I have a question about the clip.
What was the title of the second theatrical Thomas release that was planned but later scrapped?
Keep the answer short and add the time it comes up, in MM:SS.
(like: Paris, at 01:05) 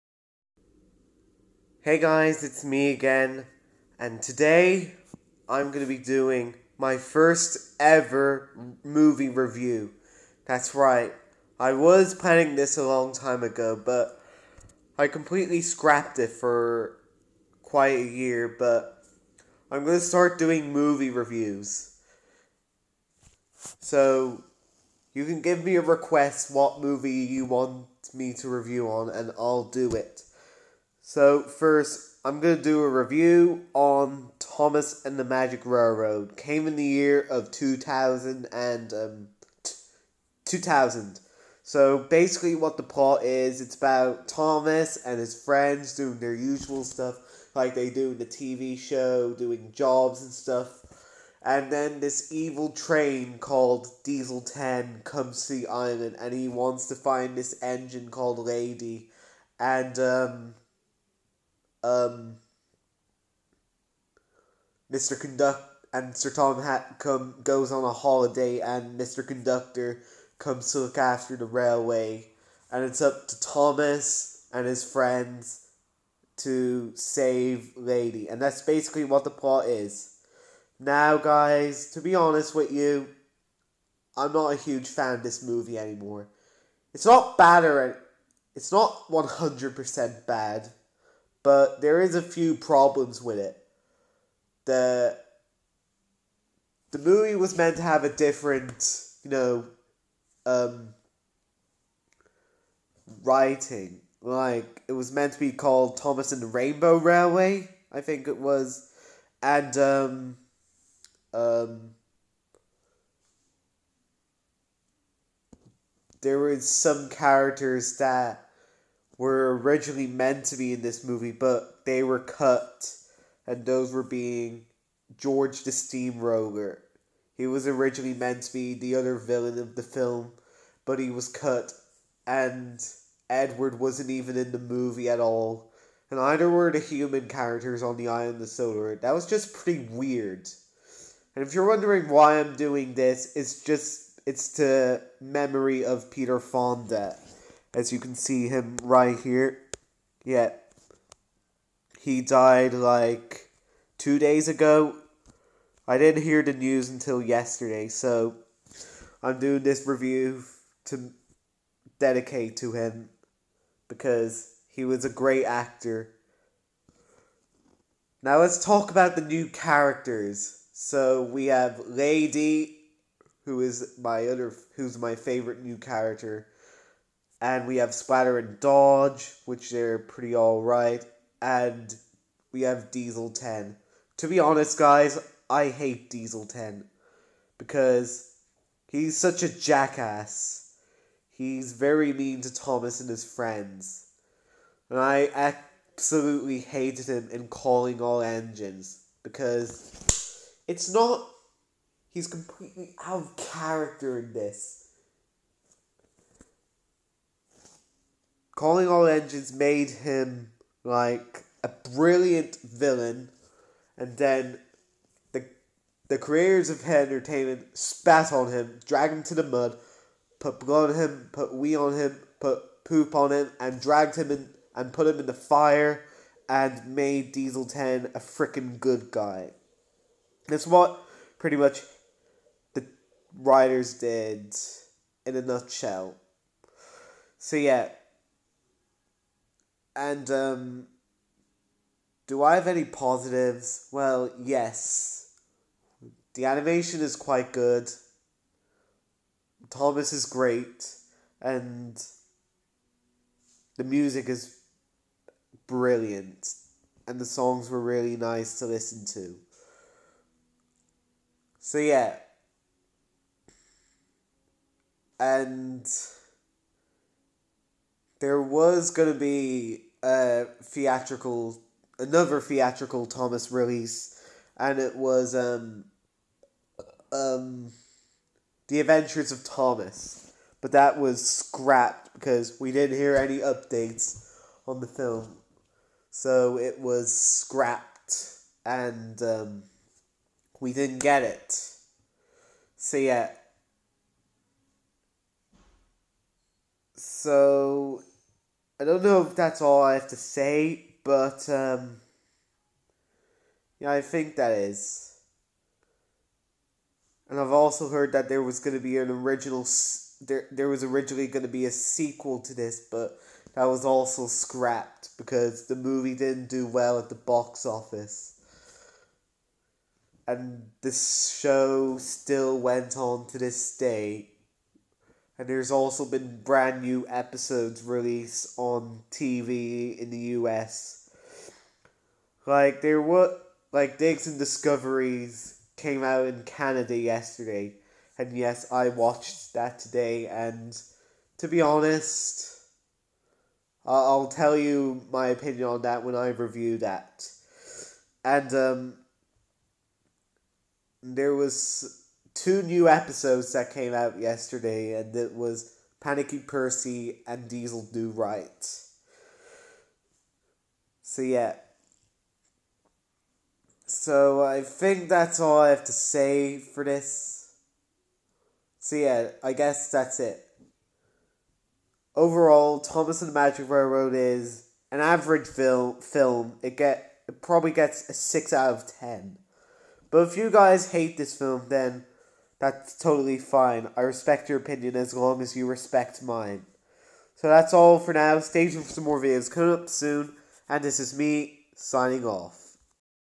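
The Adventures of Thomas, at 04:38.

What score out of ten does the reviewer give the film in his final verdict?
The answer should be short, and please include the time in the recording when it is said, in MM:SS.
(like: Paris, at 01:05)
6, at 06:18.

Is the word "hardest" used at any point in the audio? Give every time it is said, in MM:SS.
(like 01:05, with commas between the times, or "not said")
not said.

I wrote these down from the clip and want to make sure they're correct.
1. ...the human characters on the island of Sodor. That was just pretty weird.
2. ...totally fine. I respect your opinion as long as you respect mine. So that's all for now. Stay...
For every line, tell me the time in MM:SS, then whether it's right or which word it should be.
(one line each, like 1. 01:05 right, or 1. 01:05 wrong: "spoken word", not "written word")
1. 02:16 right
2. 06:22 right.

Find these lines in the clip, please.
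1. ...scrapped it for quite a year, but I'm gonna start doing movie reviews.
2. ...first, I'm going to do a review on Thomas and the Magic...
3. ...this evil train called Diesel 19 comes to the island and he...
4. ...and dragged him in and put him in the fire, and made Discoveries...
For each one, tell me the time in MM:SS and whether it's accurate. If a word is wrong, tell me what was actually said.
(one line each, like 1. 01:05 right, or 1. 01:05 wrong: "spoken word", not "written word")
1. 00:15 right
2. 00:31 right
3. 00:52 wrong: "10", not "19"
4. 03:43 wrong: "Diesel", not "Discoveries".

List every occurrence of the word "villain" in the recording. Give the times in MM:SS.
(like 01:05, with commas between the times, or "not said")
02:09, 03:32.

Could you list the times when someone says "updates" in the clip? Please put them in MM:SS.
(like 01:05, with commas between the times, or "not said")
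04:43.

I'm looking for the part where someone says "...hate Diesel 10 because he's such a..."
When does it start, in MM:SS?
03:05.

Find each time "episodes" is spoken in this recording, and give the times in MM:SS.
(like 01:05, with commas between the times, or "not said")
05:27, 05:52.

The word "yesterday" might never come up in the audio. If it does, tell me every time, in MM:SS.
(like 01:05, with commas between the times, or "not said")
02:37, 05:36, 05:54.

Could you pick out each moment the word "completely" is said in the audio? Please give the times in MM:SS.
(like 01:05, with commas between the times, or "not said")
00:15, 03:22.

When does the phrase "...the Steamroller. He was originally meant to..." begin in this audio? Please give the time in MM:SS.
02:05.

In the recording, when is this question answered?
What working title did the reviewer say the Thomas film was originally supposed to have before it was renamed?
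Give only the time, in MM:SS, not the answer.
01:45.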